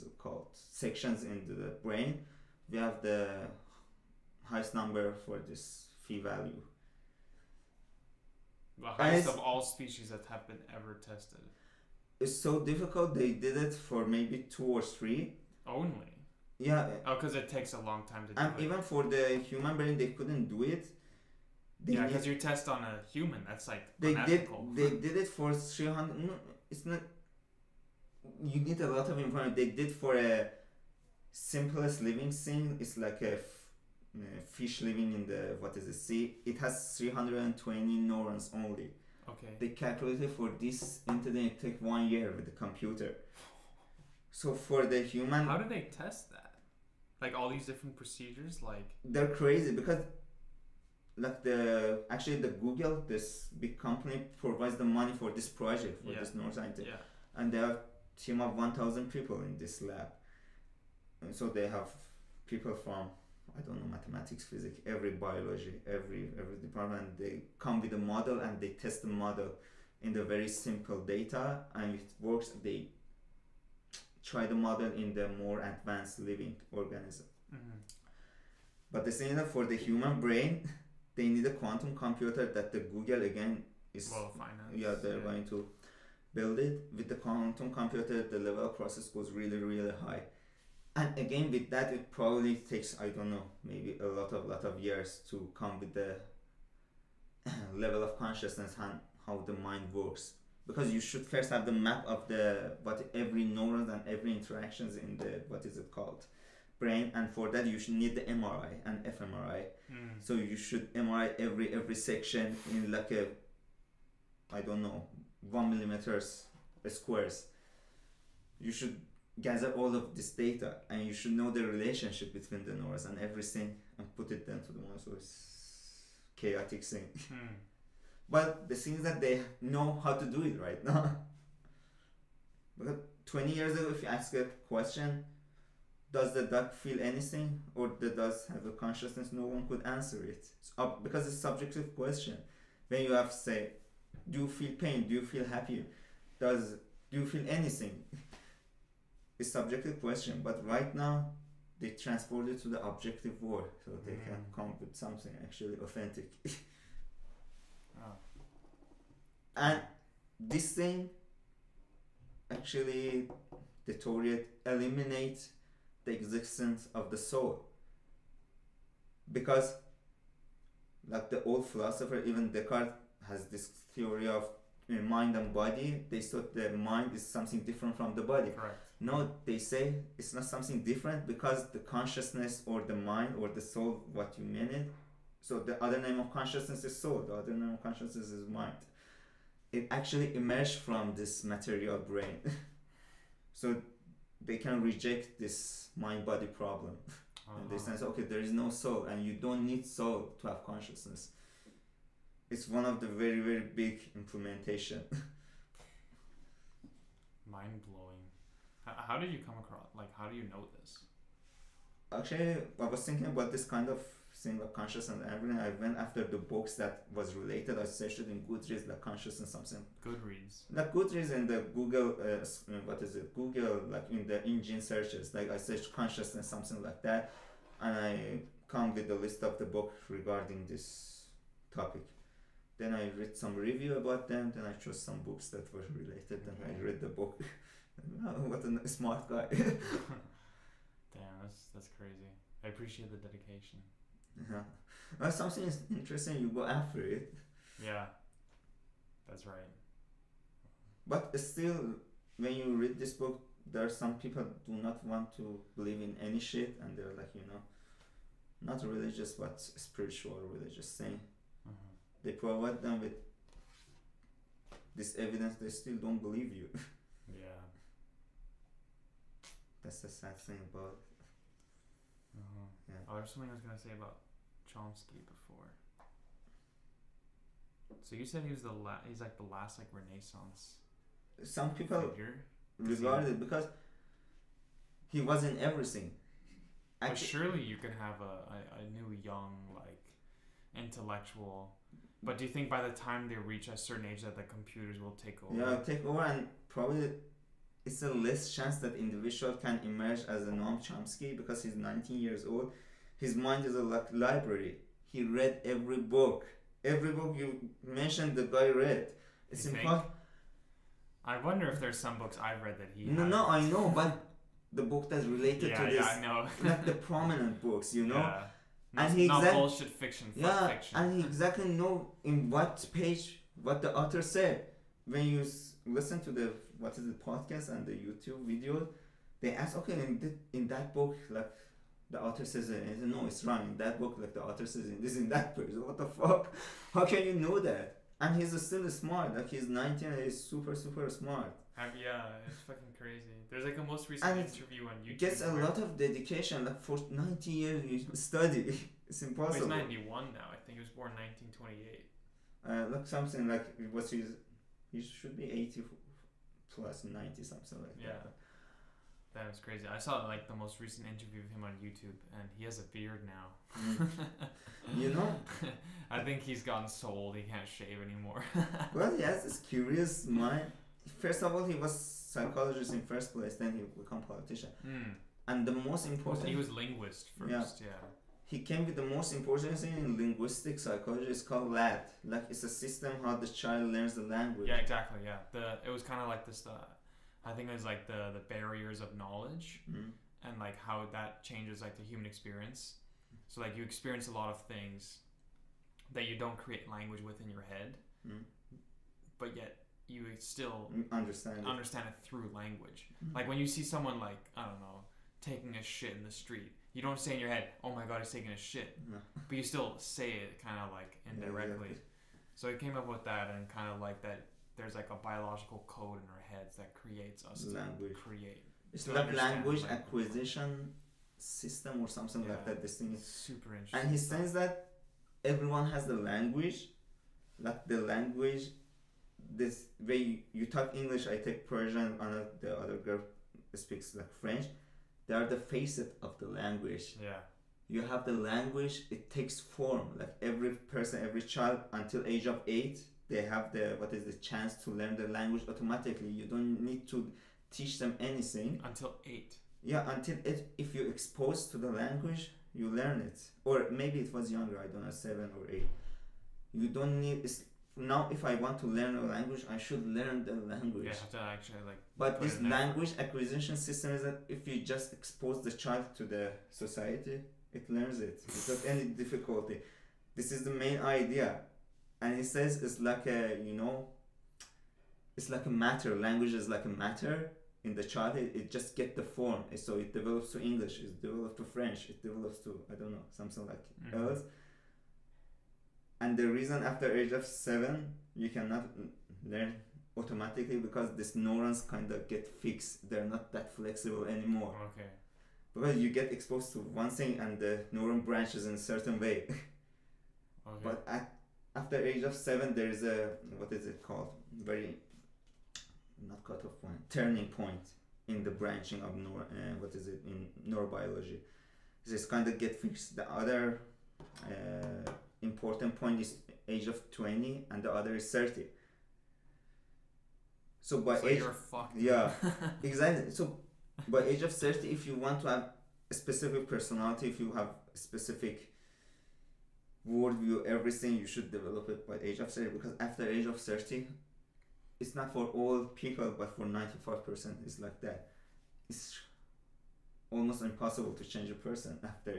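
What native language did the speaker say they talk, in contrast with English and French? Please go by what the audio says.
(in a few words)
Persian.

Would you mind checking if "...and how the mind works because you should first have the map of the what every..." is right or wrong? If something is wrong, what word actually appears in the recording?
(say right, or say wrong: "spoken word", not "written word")
right.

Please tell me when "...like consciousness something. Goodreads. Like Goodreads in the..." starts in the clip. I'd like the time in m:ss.
3:38.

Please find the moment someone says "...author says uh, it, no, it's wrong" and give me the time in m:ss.
5:32.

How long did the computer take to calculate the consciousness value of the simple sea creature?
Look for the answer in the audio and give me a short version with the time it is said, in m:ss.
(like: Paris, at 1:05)
One year, at 0:41.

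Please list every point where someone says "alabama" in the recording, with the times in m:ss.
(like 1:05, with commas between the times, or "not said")
not said.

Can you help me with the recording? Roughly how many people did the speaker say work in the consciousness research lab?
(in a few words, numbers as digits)
1000.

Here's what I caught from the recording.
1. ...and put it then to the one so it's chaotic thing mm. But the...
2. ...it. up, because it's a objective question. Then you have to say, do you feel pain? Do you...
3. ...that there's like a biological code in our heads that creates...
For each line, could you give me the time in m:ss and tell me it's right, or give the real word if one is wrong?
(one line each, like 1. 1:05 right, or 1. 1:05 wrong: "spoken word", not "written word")
1. 2:03 right
2. 2:20 wrong: "subjective", not "objective"
3. 6:54 right.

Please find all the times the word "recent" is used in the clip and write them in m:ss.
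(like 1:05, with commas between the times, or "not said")
5:44, 6:00.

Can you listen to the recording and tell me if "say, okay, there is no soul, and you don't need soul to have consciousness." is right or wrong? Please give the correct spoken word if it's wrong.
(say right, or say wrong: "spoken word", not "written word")
right.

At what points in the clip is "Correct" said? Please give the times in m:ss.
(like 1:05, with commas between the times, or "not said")
2:58.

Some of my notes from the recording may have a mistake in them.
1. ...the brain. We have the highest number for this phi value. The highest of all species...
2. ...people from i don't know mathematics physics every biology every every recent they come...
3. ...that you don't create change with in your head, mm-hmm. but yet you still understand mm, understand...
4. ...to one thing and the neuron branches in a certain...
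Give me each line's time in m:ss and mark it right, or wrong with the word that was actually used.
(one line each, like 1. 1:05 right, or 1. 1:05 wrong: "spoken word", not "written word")
1. 0:01 right
2. 1:02 wrong: "department", not "recent"
3. 6:36 wrong: "language", not "change"
4. 8:16 right.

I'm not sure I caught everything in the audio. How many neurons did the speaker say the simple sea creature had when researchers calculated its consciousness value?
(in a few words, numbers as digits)
320.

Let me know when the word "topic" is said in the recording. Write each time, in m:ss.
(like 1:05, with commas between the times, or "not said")
3:51.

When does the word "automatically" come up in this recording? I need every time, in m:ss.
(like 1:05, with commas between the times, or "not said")
7:25, 8:10.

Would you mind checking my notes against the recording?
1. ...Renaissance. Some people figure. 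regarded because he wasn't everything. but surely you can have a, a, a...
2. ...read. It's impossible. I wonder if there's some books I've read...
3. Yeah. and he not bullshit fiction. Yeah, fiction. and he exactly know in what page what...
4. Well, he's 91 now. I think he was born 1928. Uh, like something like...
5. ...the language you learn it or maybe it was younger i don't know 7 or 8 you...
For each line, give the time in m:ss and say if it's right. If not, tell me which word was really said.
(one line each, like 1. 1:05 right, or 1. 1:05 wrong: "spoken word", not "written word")
1. 4:39 right
2. 5:08 right
3. 5:18 right
4. 5:49 right
5. 7:31 right.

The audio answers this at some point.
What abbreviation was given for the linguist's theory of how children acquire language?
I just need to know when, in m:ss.
6:21.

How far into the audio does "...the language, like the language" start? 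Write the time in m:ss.
7:06.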